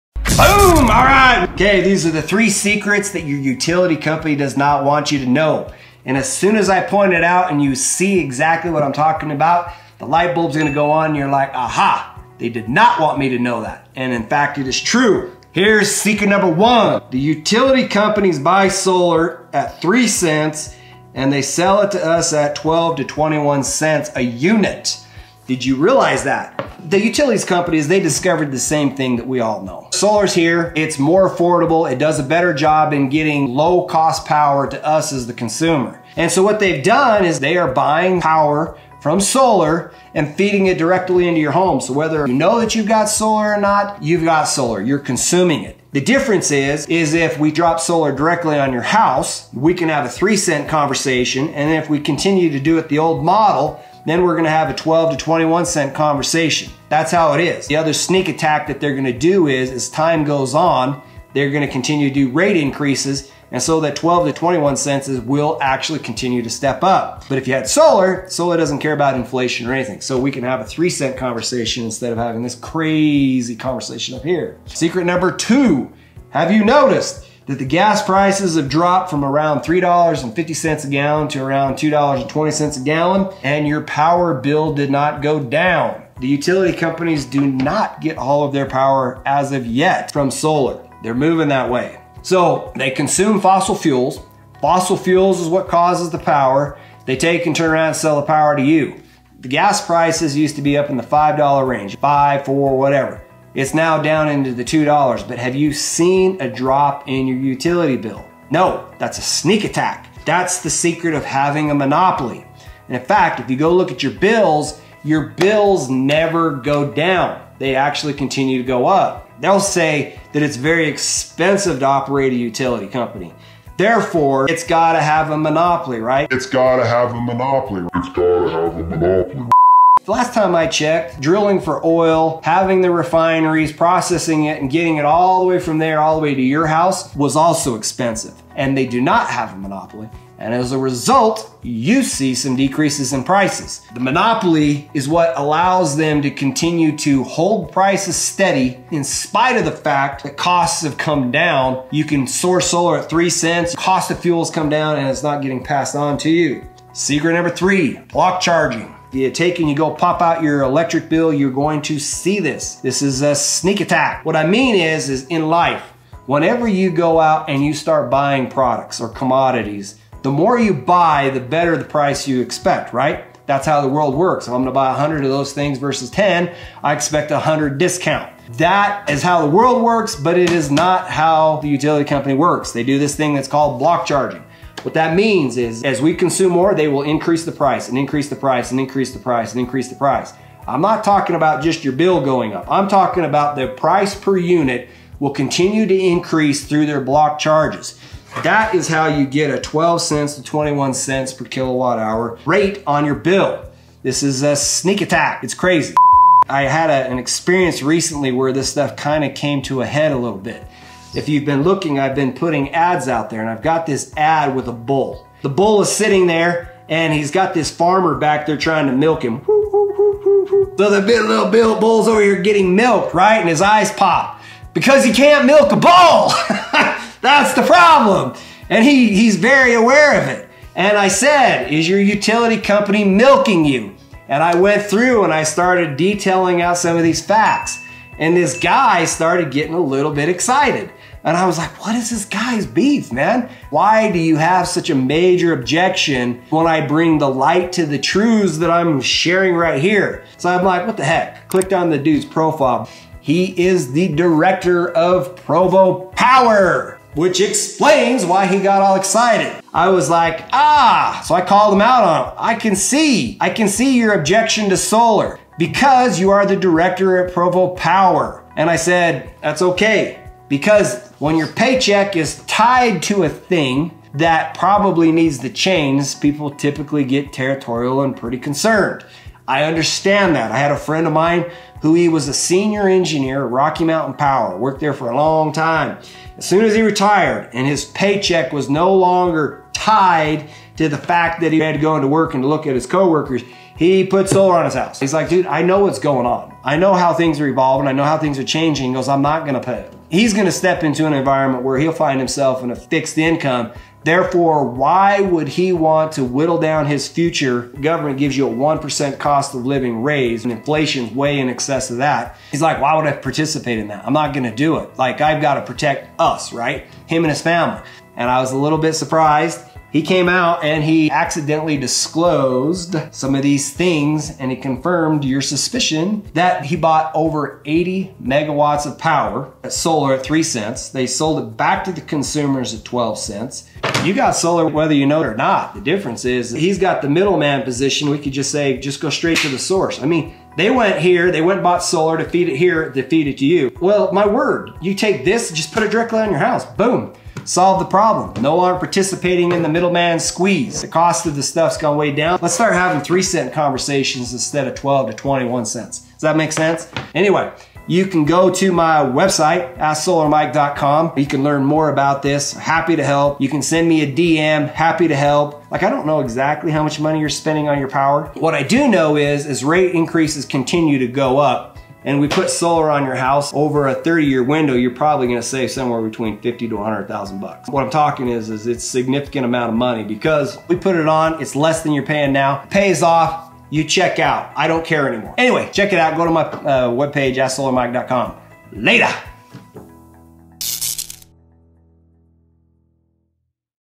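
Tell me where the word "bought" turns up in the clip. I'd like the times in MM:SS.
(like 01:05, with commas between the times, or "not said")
05:26, 05:41.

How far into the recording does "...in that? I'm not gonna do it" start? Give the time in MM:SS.
05:13.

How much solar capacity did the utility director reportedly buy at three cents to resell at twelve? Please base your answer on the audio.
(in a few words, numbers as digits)
over 80 megawatts.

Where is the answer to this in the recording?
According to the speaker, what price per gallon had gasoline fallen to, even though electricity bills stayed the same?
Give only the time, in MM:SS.
01:21.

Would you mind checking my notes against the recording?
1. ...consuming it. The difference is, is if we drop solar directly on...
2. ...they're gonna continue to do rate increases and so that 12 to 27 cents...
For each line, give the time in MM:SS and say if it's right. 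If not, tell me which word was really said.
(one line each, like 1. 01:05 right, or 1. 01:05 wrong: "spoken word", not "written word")
1. 00:44 right
2. 01:01 wrong: "21", not "27".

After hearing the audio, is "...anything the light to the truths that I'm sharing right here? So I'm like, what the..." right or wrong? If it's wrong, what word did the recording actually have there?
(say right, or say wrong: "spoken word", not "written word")
wrong: "bring", not "anything".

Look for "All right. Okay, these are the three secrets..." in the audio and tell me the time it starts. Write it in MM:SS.
00:00.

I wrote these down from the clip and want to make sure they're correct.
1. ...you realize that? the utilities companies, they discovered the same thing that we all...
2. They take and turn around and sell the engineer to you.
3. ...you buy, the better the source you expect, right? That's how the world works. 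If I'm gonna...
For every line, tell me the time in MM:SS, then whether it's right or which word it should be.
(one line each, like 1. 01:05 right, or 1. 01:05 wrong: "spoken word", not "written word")
1. 00:25 right
2. 01:37 wrong: "power", not "engineer"
3. 02:50 wrong: "price", not "source".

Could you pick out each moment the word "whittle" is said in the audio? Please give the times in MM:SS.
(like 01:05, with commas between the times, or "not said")
05:06.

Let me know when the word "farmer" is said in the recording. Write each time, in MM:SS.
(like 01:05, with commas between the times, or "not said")
03:37.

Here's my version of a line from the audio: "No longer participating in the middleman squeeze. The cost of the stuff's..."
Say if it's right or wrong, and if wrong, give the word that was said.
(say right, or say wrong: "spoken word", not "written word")
right.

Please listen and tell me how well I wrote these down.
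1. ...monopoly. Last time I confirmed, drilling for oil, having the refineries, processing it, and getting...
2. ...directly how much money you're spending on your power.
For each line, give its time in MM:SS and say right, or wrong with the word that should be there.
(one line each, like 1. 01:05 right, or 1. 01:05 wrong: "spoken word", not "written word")
1. 02:08 wrong: "checked", not "confirmed"
2. 06:06 wrong: "exactly", not "directly".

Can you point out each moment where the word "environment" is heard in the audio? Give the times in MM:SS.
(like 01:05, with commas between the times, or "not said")
05:01.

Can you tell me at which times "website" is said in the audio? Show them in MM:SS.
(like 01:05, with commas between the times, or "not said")
05:58.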